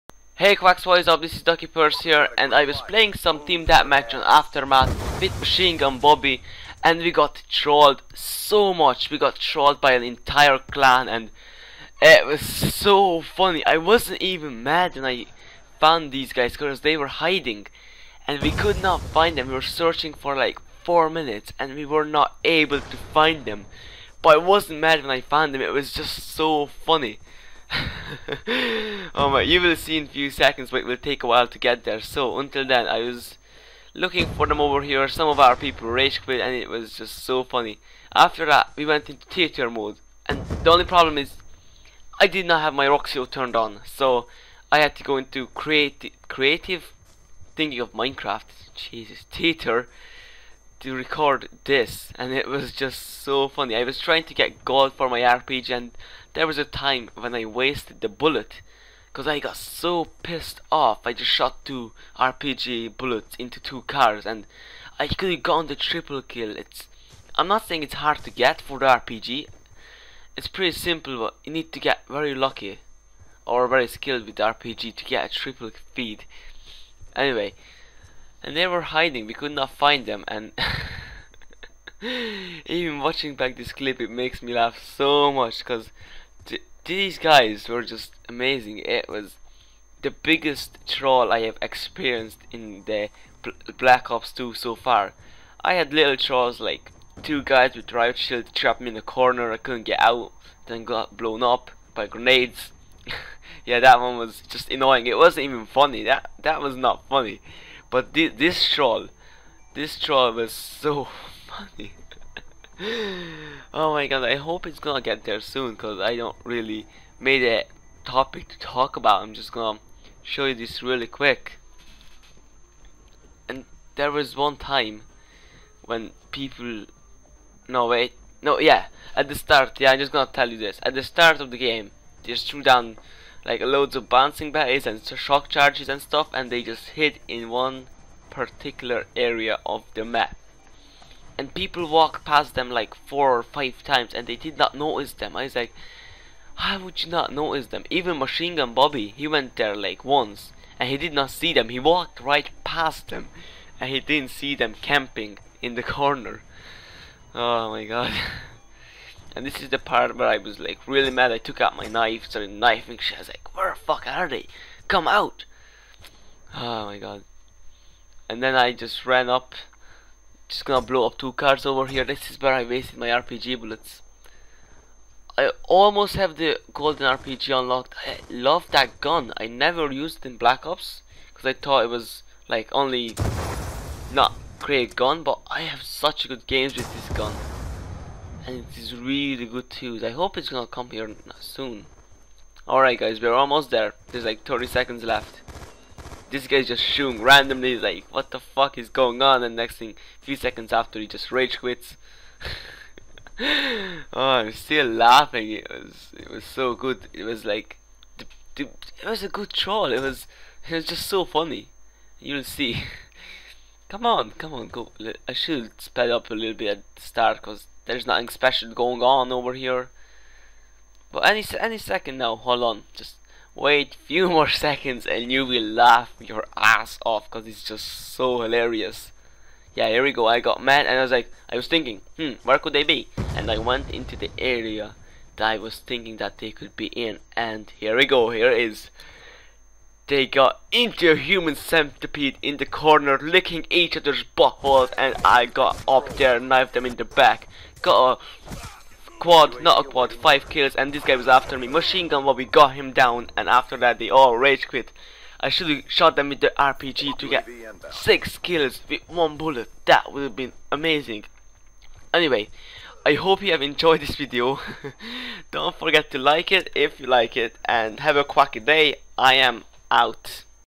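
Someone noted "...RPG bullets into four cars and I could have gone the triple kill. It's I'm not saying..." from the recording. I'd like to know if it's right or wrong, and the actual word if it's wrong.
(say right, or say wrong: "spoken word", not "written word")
wrong: "two", not "four".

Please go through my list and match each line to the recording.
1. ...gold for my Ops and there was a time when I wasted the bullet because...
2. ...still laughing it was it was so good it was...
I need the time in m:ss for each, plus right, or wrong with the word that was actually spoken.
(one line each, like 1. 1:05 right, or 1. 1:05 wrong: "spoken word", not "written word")
1. 0:54 wrong: "RPG", not "Ops"
2. 3:24 right.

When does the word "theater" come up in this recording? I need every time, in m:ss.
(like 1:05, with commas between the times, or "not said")
0:39, 0:49.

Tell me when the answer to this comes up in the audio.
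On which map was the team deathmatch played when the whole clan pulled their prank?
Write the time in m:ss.
0:04.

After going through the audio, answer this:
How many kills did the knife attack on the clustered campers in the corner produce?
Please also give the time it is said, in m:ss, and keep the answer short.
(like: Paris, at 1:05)
5, at 4:10.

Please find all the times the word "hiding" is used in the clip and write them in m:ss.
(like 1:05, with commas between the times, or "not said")
0:17, 1:18.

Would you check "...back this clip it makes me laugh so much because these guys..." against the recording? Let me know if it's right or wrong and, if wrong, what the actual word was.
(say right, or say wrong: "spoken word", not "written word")
right.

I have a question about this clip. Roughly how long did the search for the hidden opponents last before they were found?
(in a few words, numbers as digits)
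4 minutes.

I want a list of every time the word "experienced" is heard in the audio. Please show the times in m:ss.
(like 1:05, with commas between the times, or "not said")
1:31.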